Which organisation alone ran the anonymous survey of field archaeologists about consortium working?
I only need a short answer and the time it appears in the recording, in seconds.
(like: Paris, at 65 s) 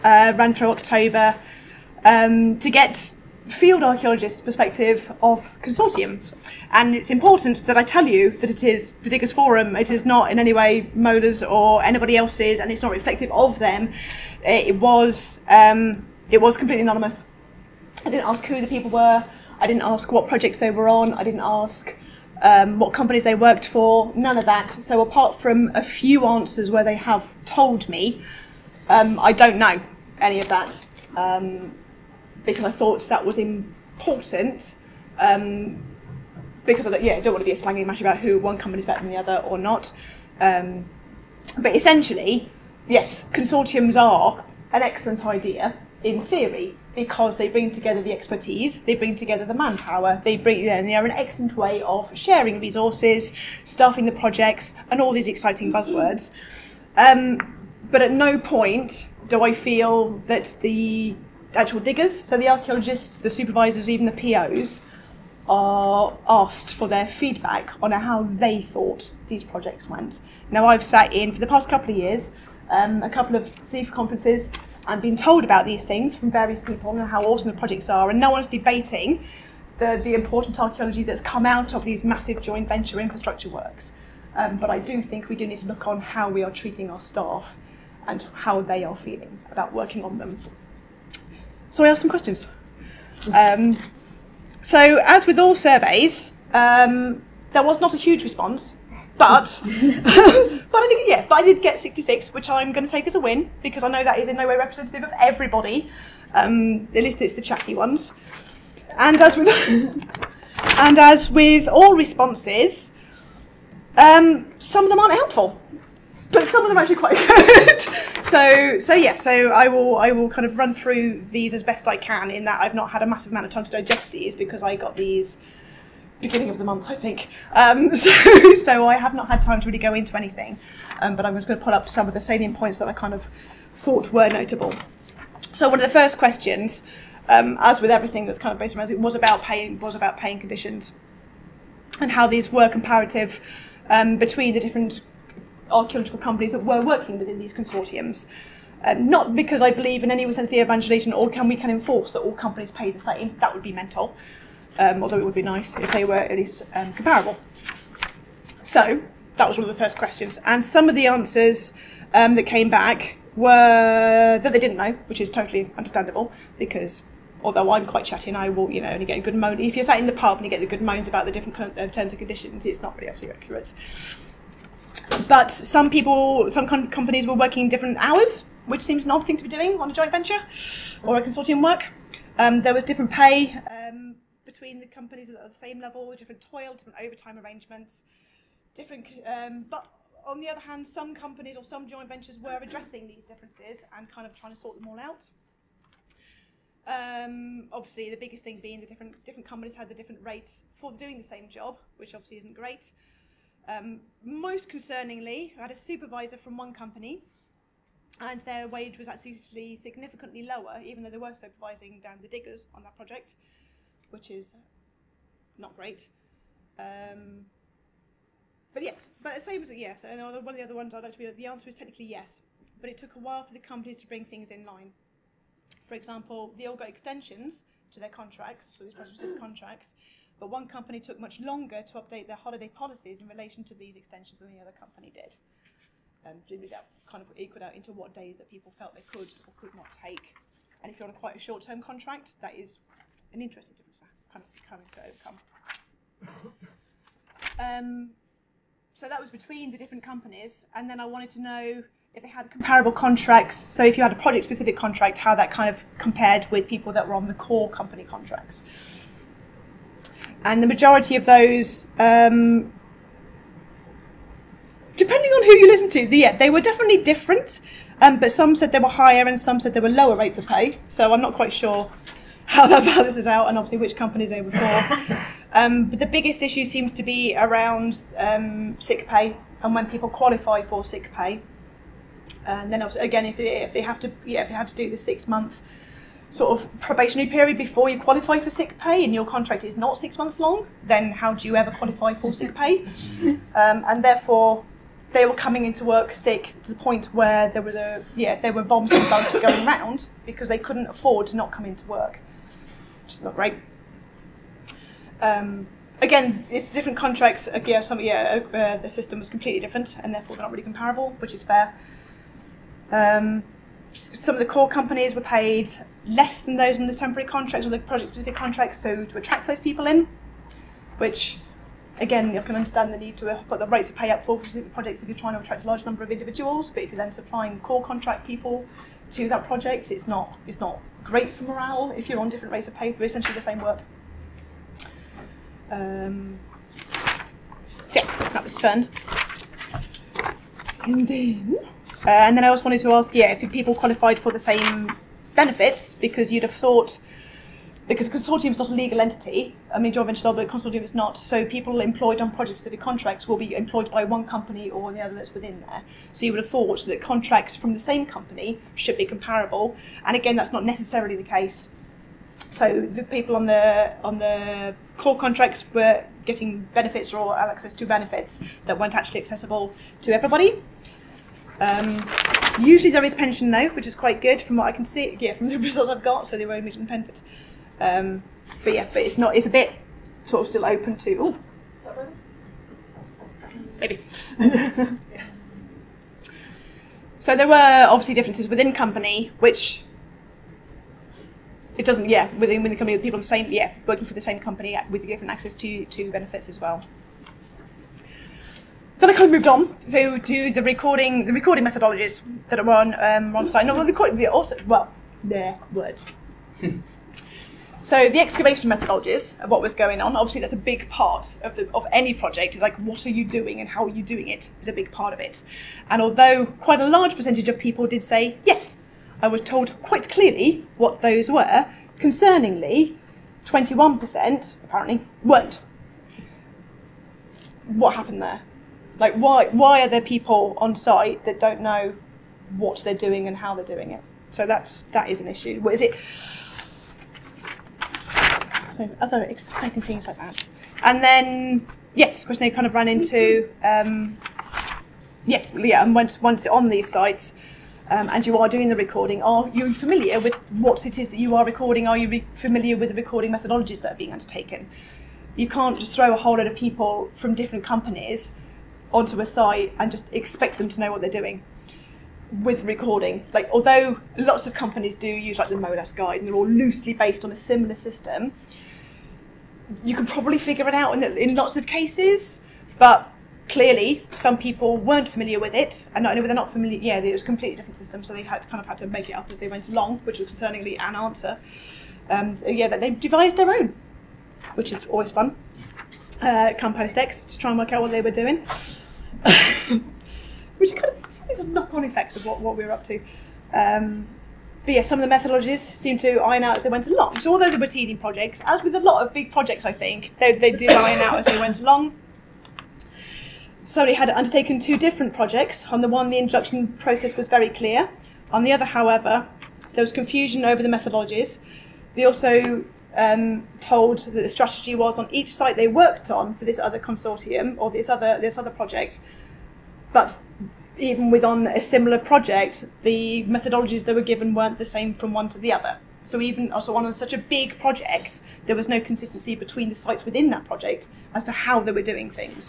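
Diggers Forum, at 9 s.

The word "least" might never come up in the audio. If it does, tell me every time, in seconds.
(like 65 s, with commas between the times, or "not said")
107 s, 156 s.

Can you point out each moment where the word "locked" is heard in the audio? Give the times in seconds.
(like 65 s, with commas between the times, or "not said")
not said.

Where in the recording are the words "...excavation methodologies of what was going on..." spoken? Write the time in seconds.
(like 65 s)
408 s.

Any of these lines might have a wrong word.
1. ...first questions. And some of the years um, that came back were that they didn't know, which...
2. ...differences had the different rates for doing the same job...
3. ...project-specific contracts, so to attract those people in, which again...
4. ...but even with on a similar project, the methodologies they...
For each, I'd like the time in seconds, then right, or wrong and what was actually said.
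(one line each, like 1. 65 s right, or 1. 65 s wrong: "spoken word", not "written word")
1. 159 s wrong: "answers", not "years"
2. 199 s wrong: "companies", not "differences"
3. 317 s right
4. 519 s right.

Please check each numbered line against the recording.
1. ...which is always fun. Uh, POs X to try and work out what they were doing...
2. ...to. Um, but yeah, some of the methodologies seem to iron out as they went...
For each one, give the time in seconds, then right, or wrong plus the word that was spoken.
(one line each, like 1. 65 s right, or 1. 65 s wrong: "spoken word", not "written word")
1. 484 s wrong: "Compost", not "POs"
2. 492 s right.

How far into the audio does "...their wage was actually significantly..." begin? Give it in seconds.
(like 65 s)
208 s.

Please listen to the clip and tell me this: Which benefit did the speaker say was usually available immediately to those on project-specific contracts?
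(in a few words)
pension.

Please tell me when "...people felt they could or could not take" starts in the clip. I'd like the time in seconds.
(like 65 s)
238 s.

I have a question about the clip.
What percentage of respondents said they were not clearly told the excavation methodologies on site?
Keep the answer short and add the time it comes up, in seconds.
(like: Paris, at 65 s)
21%, at 423 s.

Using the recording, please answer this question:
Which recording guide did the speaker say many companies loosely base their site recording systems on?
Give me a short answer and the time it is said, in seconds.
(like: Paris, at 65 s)
MoLAS guide, at 465 s.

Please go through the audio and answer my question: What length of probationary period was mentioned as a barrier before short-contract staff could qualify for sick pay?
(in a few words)
6 months.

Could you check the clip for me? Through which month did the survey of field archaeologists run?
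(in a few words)
October.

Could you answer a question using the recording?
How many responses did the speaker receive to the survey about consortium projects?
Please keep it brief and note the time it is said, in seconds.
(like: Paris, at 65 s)
66, at 101 s.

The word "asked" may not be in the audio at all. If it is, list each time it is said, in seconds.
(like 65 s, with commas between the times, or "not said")
66 s, 91 s.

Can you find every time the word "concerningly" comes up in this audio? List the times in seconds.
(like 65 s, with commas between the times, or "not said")
204 s, 422 s, 480 s.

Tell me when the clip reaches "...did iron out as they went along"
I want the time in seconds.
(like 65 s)
500 s.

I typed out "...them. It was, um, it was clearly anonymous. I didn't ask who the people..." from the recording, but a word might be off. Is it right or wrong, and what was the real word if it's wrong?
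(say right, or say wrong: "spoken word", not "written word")
wrong: "completely", not "clearly".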